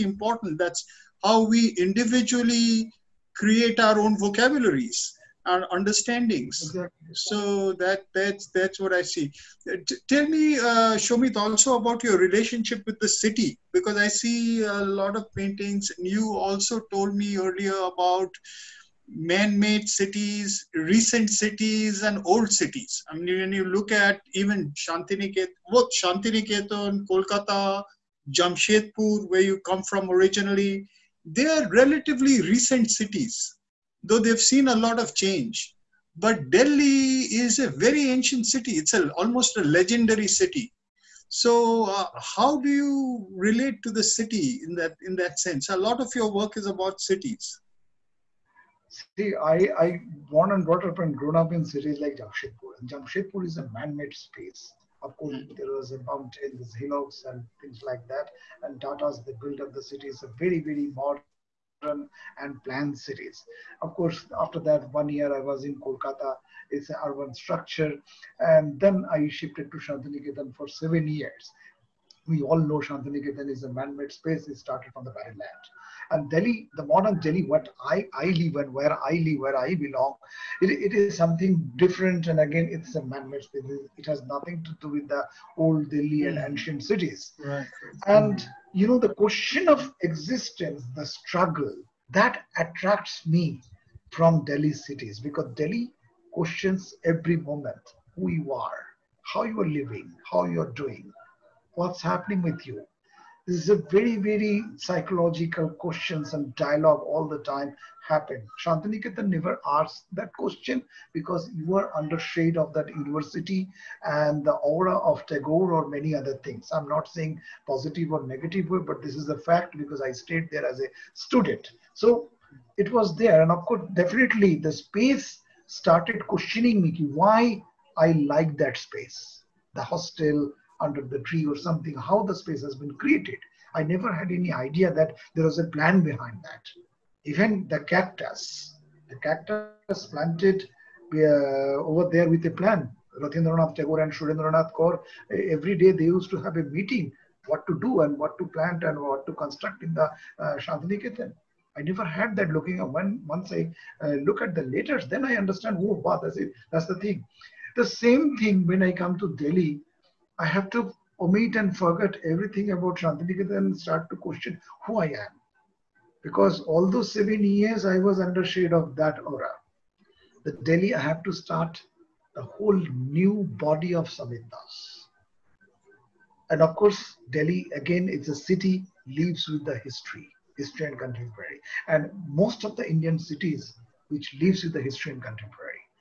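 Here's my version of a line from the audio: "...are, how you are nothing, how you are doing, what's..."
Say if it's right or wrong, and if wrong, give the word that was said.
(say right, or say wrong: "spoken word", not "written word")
wrong: "living", not "nothing".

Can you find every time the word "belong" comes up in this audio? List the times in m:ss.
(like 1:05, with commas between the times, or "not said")
1:19.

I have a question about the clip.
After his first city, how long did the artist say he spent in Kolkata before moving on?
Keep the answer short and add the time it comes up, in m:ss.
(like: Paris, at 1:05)
1 year, at 1:04.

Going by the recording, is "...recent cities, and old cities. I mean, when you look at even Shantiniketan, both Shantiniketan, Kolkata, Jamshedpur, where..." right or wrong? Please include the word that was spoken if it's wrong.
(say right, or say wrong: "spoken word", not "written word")
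right.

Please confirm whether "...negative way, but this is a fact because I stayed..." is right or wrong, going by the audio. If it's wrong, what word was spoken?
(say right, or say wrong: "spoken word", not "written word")
right.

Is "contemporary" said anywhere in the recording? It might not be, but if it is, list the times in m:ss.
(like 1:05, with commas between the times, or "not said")
3:00, 3:05.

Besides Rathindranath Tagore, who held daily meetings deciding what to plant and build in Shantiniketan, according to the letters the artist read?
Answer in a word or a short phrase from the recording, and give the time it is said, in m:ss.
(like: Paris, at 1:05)
Surendranath Kar, at 2:24.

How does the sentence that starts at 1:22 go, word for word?
And again, it's a man-made space.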